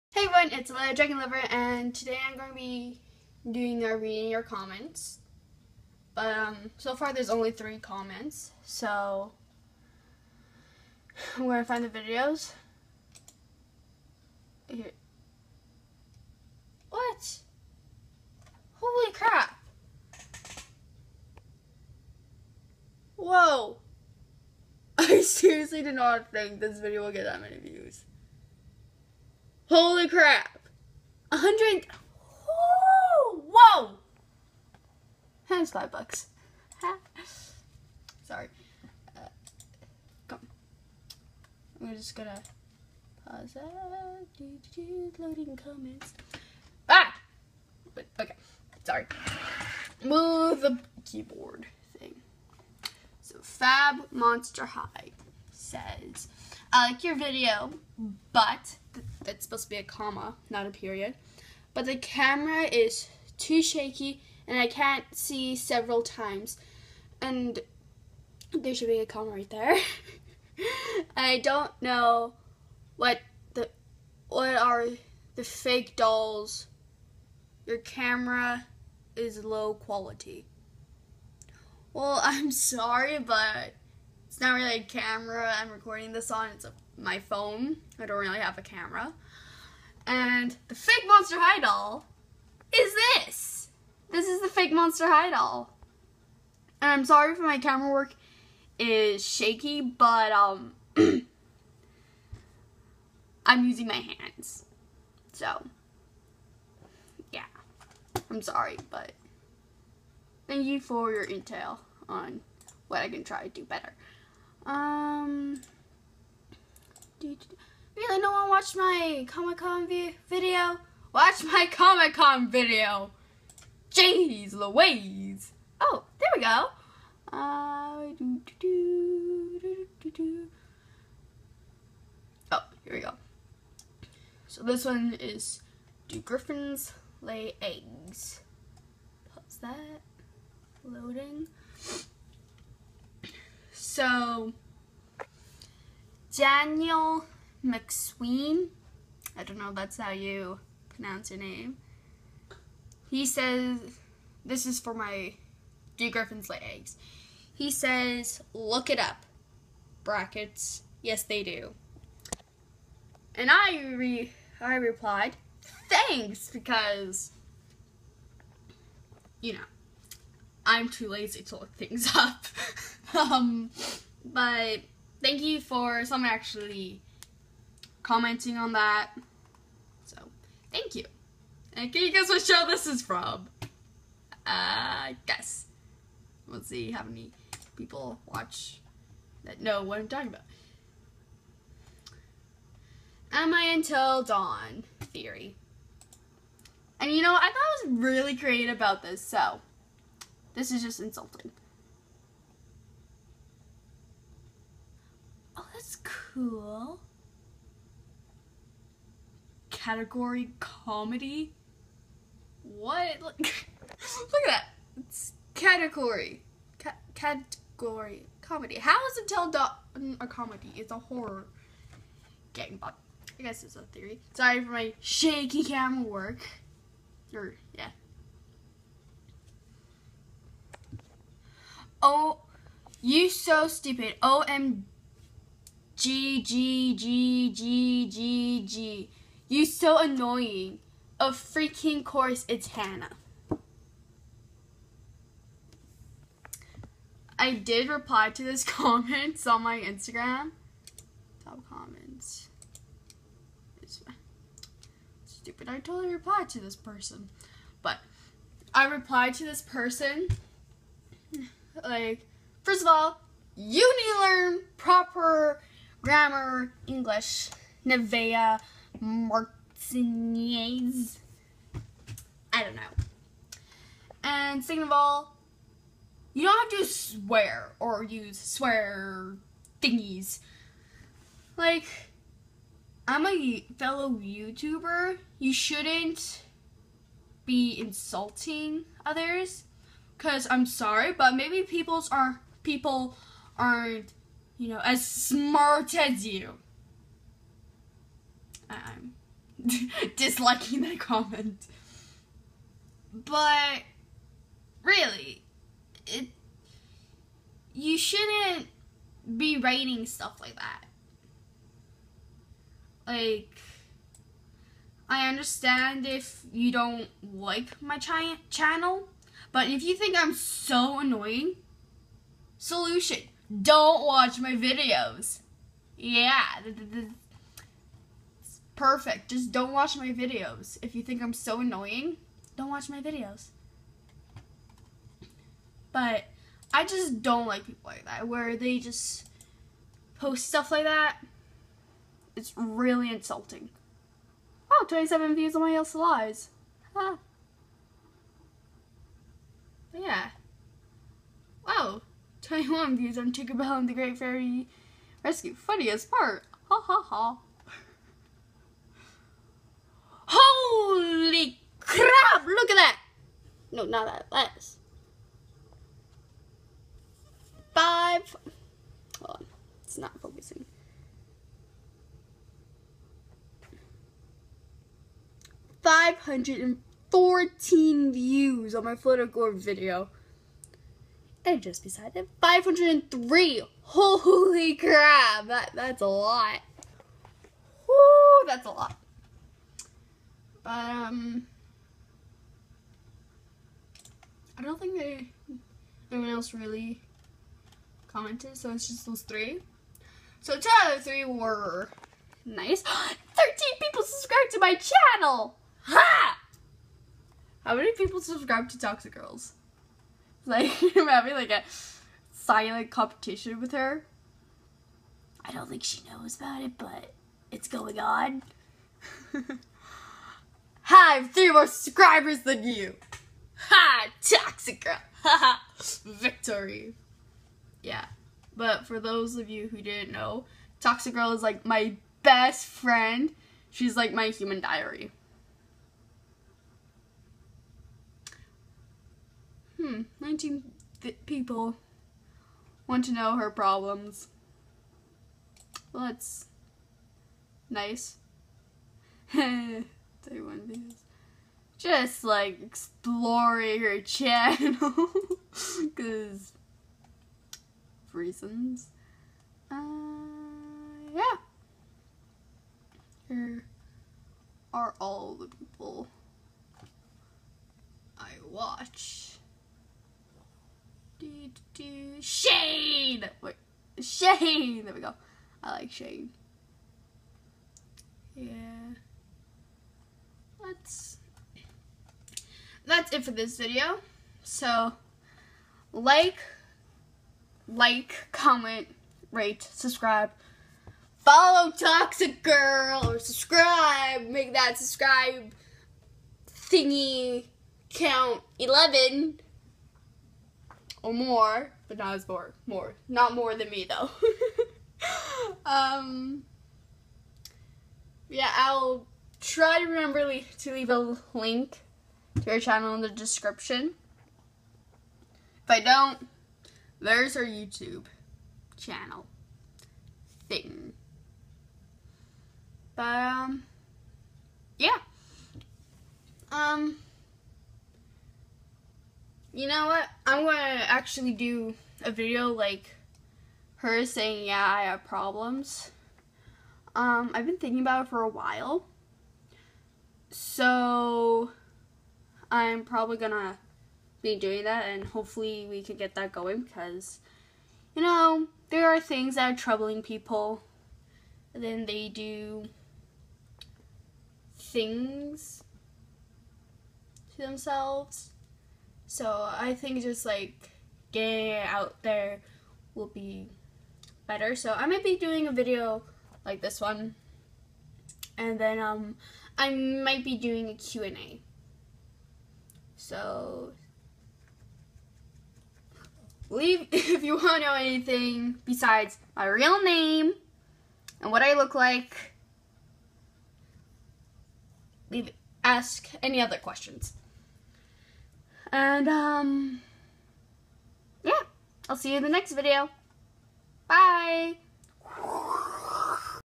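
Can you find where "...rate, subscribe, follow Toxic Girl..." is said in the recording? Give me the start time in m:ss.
8:09.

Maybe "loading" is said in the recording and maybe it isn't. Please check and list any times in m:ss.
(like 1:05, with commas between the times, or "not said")
0:45, 2:20.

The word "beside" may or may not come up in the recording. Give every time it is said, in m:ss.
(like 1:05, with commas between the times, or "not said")
6:21, 9:38.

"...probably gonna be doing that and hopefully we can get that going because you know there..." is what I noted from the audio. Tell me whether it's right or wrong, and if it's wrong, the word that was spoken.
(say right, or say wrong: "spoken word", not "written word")
right.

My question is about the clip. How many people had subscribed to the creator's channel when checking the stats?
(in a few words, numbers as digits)
13.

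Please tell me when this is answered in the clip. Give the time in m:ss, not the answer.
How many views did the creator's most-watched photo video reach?
6:15.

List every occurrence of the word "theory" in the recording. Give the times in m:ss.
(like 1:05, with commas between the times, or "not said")
3:14, 3:43.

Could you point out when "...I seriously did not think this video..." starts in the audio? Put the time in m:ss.
0:24.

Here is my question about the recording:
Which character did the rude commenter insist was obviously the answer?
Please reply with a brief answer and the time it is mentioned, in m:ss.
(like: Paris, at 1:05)
Hannah, at 4:02.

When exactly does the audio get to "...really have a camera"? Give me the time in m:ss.
1:28.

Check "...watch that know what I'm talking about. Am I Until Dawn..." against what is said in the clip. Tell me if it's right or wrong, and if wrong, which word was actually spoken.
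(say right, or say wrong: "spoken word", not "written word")
right.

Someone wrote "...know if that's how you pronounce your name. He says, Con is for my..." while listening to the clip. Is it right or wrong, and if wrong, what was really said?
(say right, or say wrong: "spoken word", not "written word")
wrong: "This", not "Con".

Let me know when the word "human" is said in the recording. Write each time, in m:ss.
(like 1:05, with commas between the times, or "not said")
7:14.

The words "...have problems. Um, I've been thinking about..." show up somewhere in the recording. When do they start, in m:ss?
8:54.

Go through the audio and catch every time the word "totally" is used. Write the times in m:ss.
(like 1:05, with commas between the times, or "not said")
4:15.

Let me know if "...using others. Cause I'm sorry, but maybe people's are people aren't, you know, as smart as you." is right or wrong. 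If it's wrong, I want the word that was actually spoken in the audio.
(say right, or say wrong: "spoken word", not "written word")
wrong: "insulting", not "using".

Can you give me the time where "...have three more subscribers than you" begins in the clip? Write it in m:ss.
7:01.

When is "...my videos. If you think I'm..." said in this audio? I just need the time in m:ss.
5:29.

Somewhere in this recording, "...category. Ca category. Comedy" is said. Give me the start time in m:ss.
3:35.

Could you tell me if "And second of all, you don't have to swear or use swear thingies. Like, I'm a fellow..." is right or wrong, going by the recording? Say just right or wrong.
right.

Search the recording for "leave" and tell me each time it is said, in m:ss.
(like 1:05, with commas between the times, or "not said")
8:30, 9:36, 9:45.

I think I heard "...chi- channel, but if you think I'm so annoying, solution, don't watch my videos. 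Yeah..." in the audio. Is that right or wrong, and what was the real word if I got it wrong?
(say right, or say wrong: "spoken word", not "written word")
right.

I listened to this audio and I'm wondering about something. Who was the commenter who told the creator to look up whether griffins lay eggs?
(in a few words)
Daniel McSween.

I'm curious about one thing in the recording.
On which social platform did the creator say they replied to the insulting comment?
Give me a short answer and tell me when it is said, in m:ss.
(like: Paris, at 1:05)
Instagram, at 4:09.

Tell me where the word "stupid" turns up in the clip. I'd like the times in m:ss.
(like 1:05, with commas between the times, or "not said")
3:53, 4:15.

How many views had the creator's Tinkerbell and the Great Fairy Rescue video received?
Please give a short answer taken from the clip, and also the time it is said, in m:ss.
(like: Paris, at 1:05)
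21, at 5:52.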